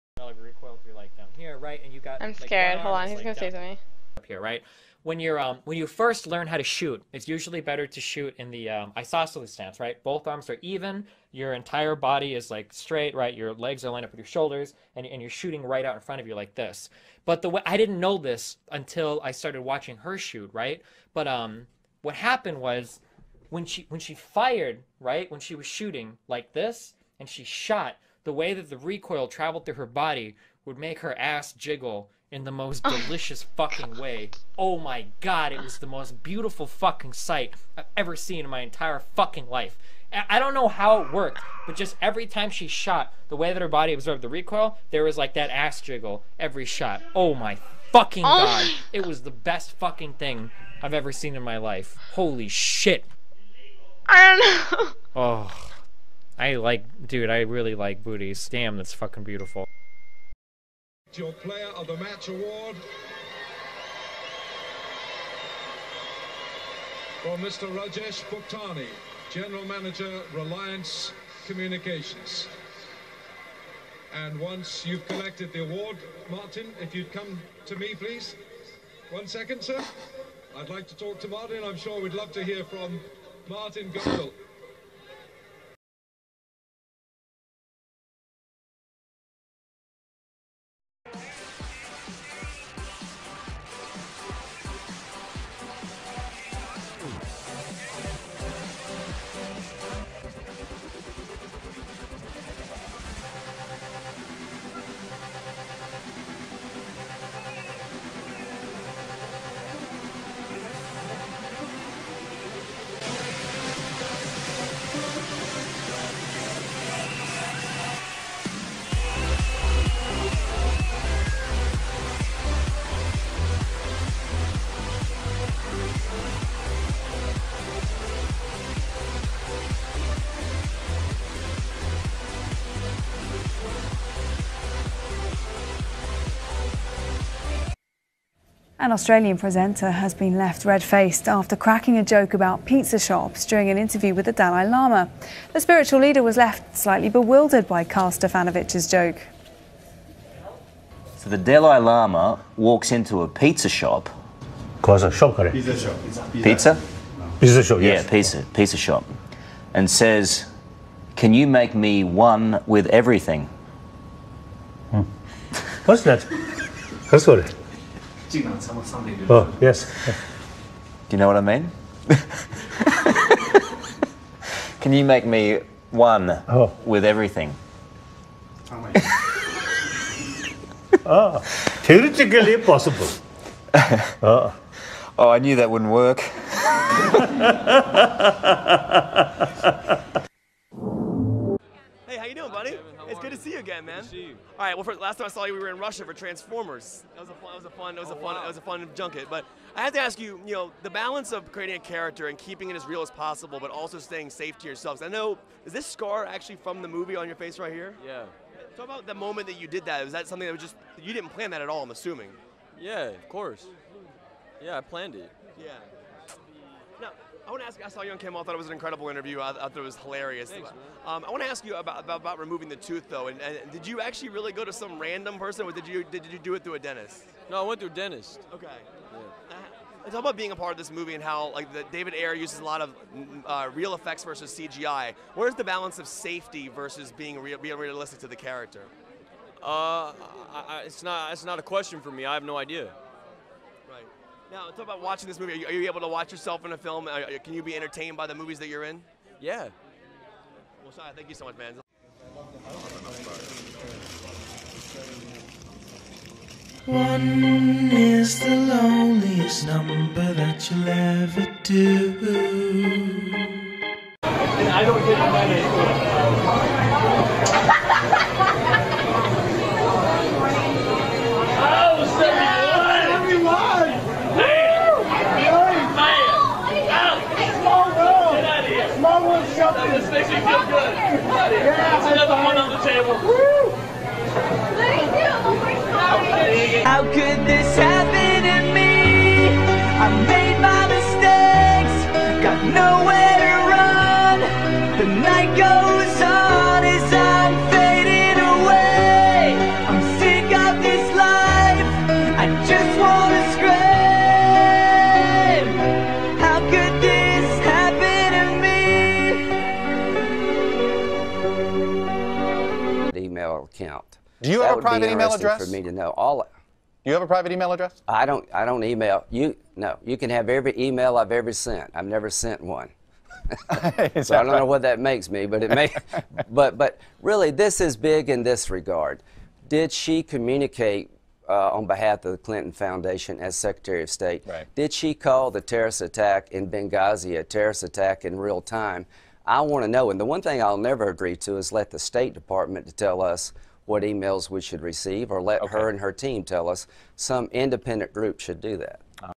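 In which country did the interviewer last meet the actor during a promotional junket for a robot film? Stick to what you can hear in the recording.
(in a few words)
Russia.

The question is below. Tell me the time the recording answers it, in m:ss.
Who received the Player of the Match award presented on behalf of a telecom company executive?
1:07.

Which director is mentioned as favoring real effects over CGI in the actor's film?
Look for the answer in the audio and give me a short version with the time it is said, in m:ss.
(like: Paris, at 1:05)
David Ayer, at 3:51.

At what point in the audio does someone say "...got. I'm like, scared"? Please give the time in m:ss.
0:01.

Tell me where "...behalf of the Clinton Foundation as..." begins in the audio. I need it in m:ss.
5:31.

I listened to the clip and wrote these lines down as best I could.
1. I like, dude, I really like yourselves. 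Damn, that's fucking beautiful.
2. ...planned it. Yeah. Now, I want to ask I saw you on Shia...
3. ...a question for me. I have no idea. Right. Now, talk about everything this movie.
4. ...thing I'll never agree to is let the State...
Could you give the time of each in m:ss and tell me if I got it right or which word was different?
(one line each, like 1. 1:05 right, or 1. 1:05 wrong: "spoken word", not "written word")
1. 0:56 wrong: "booties", not "yourselves"
2. 3:34 wrong: "Kimmel", not "Shia"
3. 4:01 wrong: "watching", not "everything"
4. 5:40 right.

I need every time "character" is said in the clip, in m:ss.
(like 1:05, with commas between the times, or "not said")
3:21, 3:58.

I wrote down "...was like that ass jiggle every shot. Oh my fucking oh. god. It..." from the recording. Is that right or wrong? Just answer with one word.
right.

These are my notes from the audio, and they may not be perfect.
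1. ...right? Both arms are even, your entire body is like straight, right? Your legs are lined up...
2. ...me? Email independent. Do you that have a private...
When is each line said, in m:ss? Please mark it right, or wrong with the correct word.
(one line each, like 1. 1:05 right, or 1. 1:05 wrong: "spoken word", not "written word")
1. 0:09 right
2. 5:13 wrong: "account", not "independent".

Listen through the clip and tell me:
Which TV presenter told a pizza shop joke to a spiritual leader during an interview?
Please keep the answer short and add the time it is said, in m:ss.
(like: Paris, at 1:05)
Karl Stefanovic, at 2:27.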